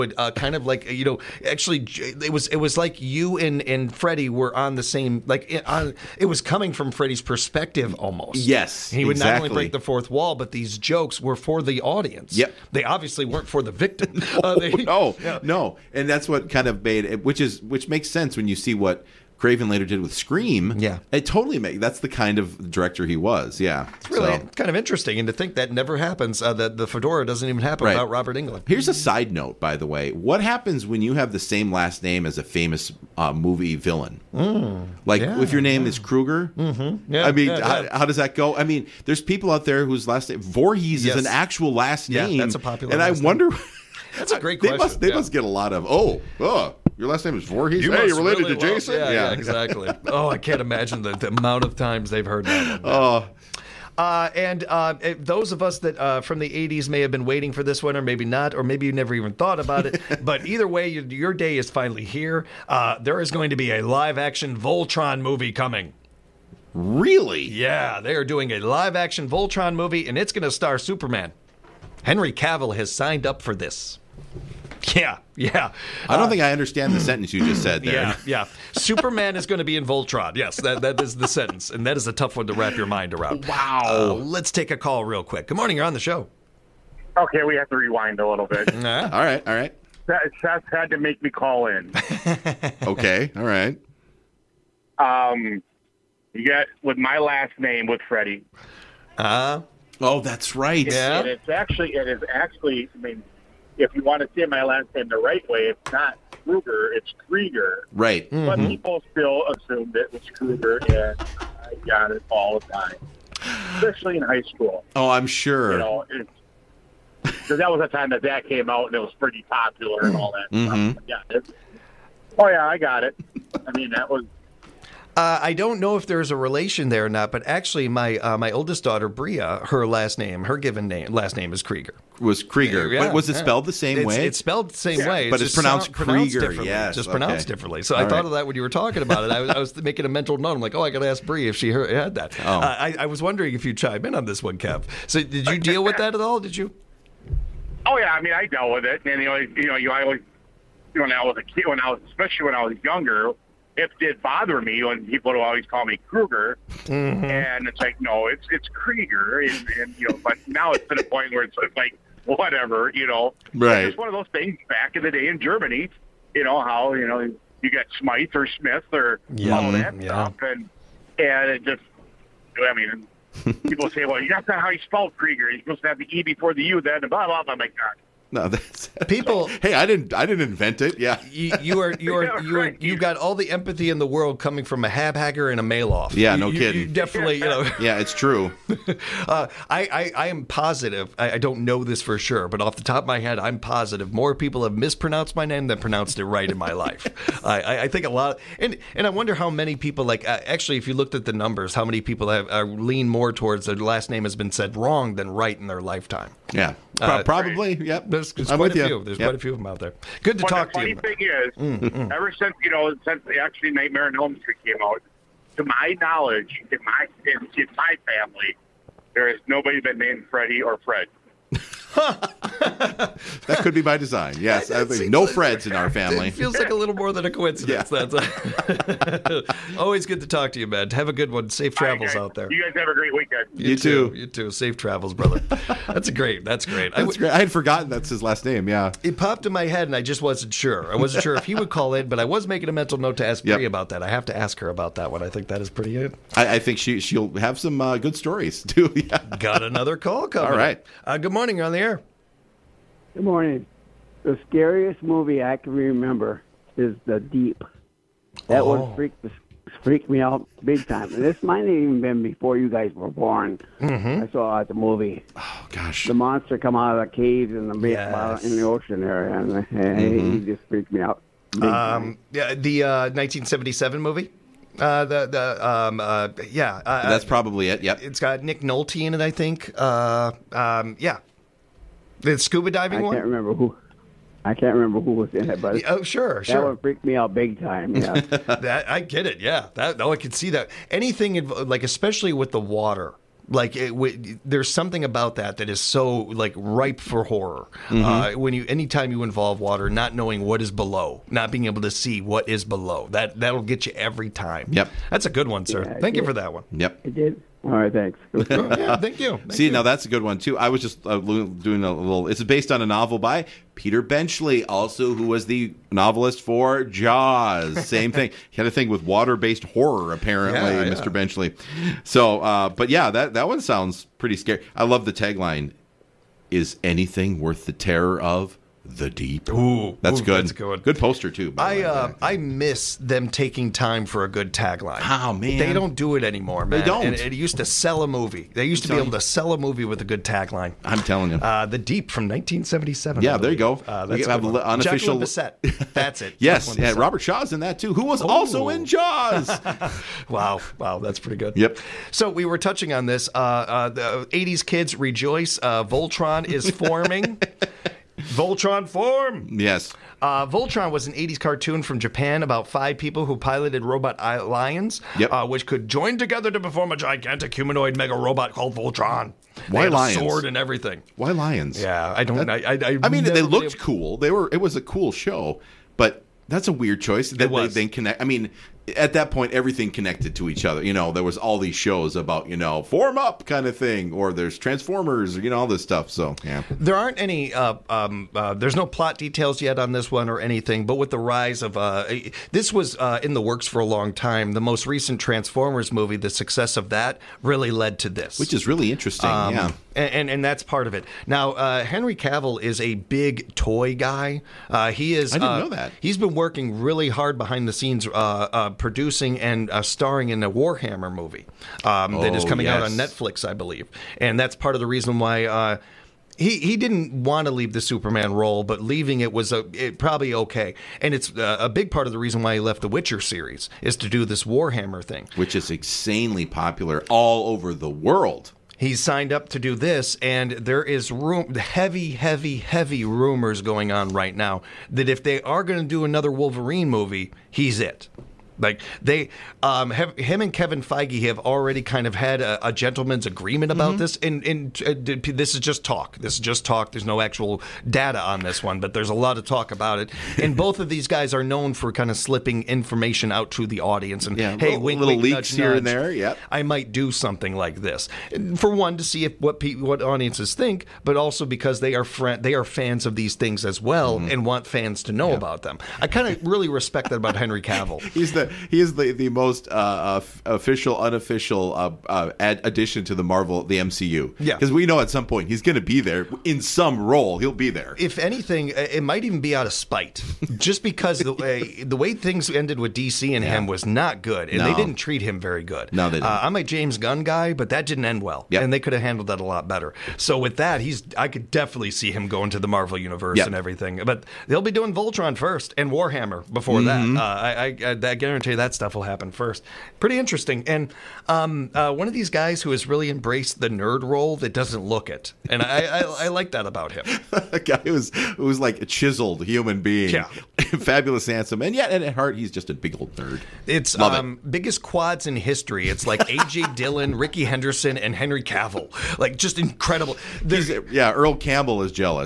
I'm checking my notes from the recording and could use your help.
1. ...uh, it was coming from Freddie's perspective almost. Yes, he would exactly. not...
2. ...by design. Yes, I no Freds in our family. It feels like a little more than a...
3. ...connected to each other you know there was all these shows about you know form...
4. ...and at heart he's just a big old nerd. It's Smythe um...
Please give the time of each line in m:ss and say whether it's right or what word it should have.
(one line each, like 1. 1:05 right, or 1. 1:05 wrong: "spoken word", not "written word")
1. 0:05 right
2. 3:43 right
3. 6:19 right
4. 8:31 wrong: "Love", not "Smythe".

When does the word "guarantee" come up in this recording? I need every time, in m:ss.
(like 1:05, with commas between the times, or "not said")
8:18.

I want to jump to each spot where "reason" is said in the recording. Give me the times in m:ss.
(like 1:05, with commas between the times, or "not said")
6:54, 7:02.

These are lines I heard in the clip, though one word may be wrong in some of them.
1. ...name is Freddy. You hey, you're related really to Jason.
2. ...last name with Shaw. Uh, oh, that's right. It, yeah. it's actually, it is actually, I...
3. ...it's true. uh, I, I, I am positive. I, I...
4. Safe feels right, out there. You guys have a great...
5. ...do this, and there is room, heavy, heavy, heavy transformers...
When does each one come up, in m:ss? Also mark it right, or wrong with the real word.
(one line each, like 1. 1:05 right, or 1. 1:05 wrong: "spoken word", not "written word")
1. 0:47 wrong: "Voorhees", not "Freddy"
2. 1:37 wrong: "Freddie", not "Shaw"
3. 3:07 right
4. 3:51 wrong: "travels", not "feels"
5. 7:09 wrong: "rumors", not "transformers".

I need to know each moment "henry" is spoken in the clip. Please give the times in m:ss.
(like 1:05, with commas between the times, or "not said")
1:12, 6:41, 7:47, 8:38.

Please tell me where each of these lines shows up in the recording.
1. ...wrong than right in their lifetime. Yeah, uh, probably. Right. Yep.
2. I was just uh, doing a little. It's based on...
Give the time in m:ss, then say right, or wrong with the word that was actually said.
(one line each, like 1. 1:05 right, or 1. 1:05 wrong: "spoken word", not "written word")
1. 3:24 right
2. 5:10 right.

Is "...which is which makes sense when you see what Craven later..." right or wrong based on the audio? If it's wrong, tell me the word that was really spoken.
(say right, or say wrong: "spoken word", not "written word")
right.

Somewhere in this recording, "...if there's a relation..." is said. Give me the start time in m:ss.
2:05.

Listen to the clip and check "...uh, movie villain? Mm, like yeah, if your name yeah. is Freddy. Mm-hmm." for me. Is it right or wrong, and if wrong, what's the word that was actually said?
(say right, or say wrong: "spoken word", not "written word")
wrong: "Kruger", not "Freddy".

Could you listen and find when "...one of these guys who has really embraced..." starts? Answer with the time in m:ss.
8:21.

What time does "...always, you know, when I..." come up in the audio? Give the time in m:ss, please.
2:30.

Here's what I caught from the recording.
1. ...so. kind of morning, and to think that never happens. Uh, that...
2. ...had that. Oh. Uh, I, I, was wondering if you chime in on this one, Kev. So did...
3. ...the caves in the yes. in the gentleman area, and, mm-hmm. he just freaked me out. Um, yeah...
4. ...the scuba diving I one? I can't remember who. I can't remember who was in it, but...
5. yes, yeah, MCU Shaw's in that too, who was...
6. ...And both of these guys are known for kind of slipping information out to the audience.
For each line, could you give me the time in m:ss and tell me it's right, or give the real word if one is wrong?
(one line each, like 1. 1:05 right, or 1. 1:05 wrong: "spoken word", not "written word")
1. 0:24 wrong: "interesting", not "morning"
2. 2:21 right
3. 4:27 wrong: "ocean", not "gentleman"
4. 4:42 right
5. 5:46 wrong: "Robert", not "MCU"
6. 7:30 right.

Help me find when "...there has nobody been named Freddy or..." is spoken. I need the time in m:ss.
3:39.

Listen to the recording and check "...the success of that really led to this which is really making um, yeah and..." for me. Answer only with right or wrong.
wrong.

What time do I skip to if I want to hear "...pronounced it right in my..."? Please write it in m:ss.
3:15.